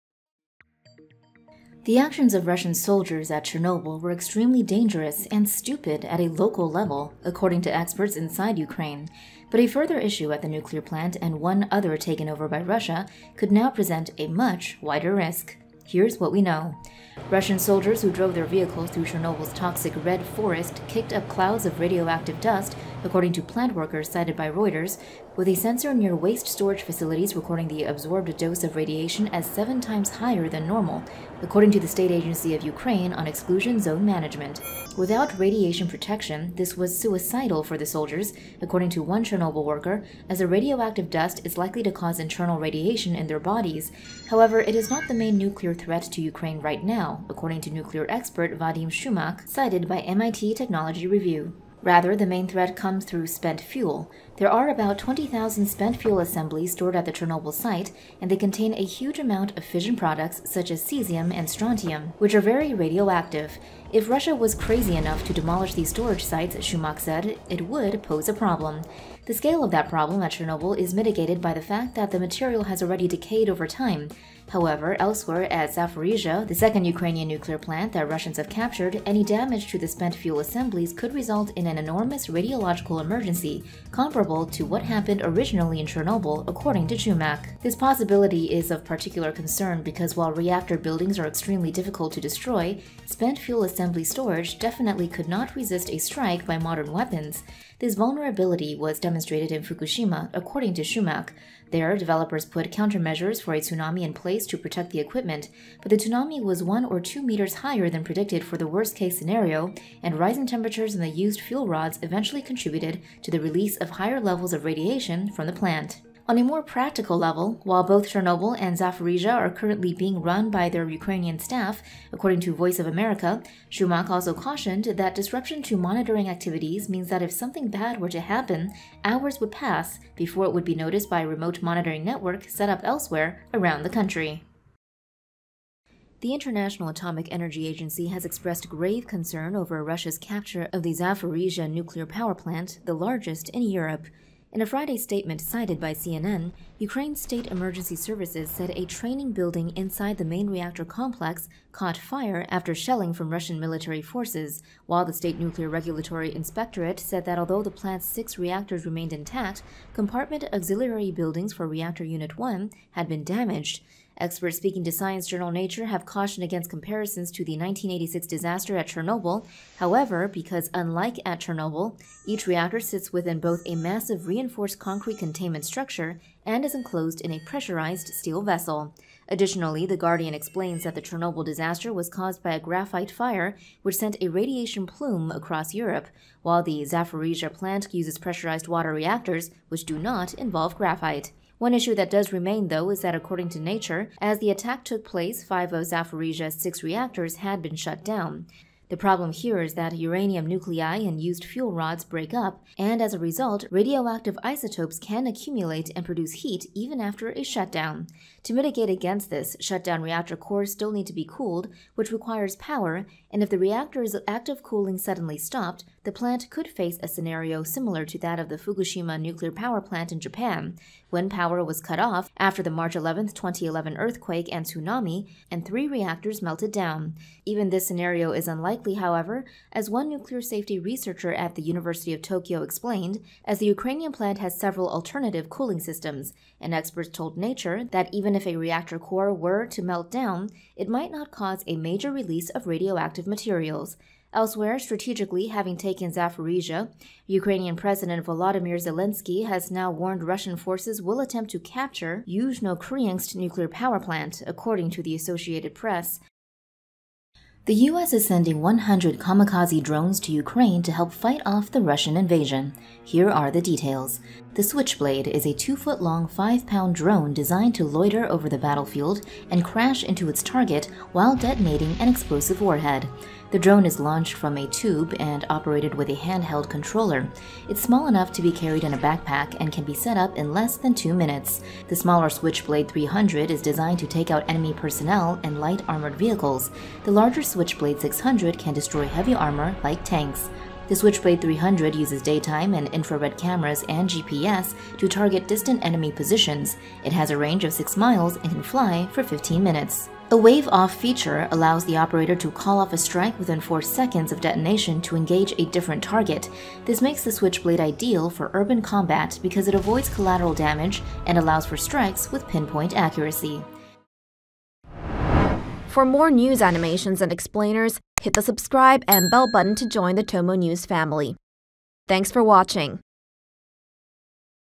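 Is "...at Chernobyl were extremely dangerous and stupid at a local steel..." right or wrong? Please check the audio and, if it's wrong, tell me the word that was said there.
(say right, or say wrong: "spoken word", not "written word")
wrong: "level", not "steel".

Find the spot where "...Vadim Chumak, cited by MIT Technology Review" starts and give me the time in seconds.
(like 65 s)
48 s.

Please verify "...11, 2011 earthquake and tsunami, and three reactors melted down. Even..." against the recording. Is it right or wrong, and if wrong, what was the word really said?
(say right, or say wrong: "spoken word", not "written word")
right.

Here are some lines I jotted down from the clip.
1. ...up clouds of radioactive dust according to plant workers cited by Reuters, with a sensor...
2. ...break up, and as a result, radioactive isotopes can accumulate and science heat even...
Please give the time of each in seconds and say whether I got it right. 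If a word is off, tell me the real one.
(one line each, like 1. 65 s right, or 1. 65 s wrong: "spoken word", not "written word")
1. 21 s right
2. 202 s wrong: "produce", not "science".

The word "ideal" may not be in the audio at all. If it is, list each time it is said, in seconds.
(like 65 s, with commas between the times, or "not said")
307 s.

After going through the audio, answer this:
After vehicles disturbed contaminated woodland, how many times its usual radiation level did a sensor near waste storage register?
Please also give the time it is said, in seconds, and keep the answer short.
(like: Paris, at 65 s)
7, at 29 s.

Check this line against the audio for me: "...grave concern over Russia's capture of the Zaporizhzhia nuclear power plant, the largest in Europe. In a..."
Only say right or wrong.
right.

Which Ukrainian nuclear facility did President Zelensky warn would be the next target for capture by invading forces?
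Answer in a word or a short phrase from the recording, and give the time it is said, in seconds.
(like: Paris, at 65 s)
Yuzhnoukrainsk, at 252 s.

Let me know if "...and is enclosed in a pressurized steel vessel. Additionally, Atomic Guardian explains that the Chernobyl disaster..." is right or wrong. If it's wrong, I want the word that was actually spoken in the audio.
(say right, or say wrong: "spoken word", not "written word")
wrong: "The", not "Atomic".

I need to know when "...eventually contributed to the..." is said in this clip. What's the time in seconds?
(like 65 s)
112 s.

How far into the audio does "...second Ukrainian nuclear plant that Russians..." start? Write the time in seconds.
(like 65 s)
76 s.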